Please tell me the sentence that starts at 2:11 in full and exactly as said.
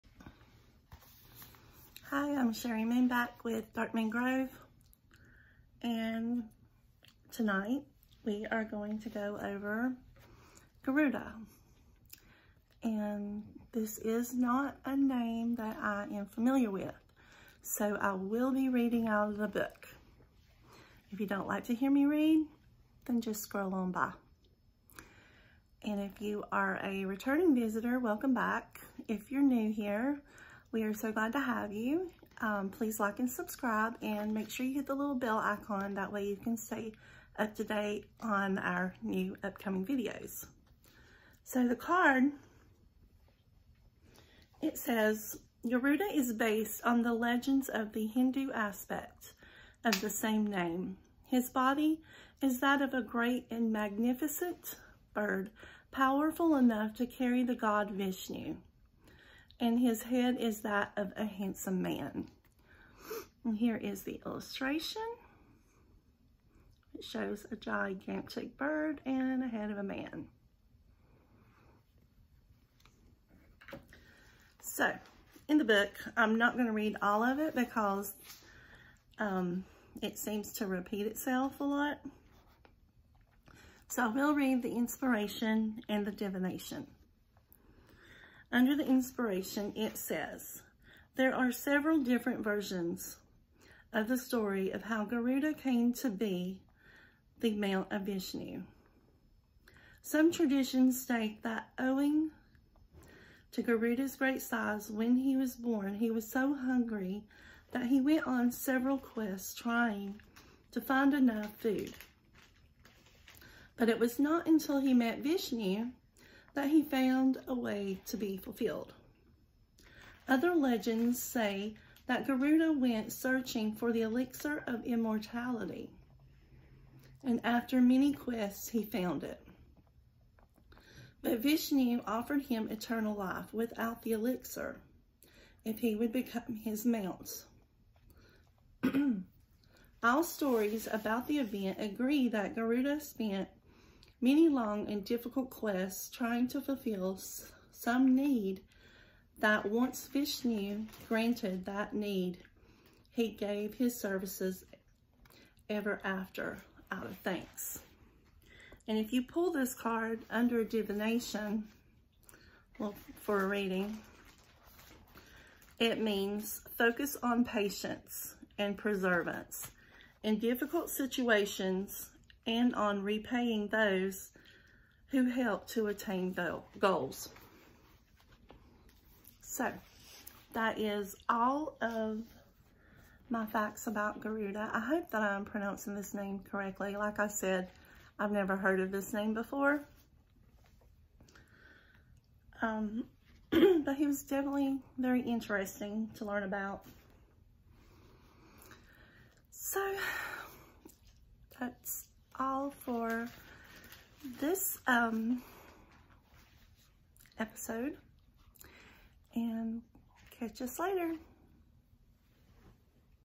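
But Vishnu offered him eternal life without the elixir if he would become his mount.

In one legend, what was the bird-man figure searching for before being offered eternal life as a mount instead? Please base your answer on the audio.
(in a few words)
elixir of immortality.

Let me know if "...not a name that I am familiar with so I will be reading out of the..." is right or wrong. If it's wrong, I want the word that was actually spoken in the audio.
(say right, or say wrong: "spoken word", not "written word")
right.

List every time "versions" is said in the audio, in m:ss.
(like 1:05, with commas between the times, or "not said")
1:32.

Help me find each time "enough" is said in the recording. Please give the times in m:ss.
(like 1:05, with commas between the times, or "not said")
0:56, 1:51.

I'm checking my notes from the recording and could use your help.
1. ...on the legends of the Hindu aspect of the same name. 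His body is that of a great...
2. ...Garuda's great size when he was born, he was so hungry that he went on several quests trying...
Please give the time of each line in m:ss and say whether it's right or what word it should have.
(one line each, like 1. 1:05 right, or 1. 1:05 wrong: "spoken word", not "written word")
1. 0:46 right
2. 1:43 right.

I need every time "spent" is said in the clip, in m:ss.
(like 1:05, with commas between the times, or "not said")
2:22.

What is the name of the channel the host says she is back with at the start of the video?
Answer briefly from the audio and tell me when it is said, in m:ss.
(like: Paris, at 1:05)
Dark Moon Grove, at 0:03.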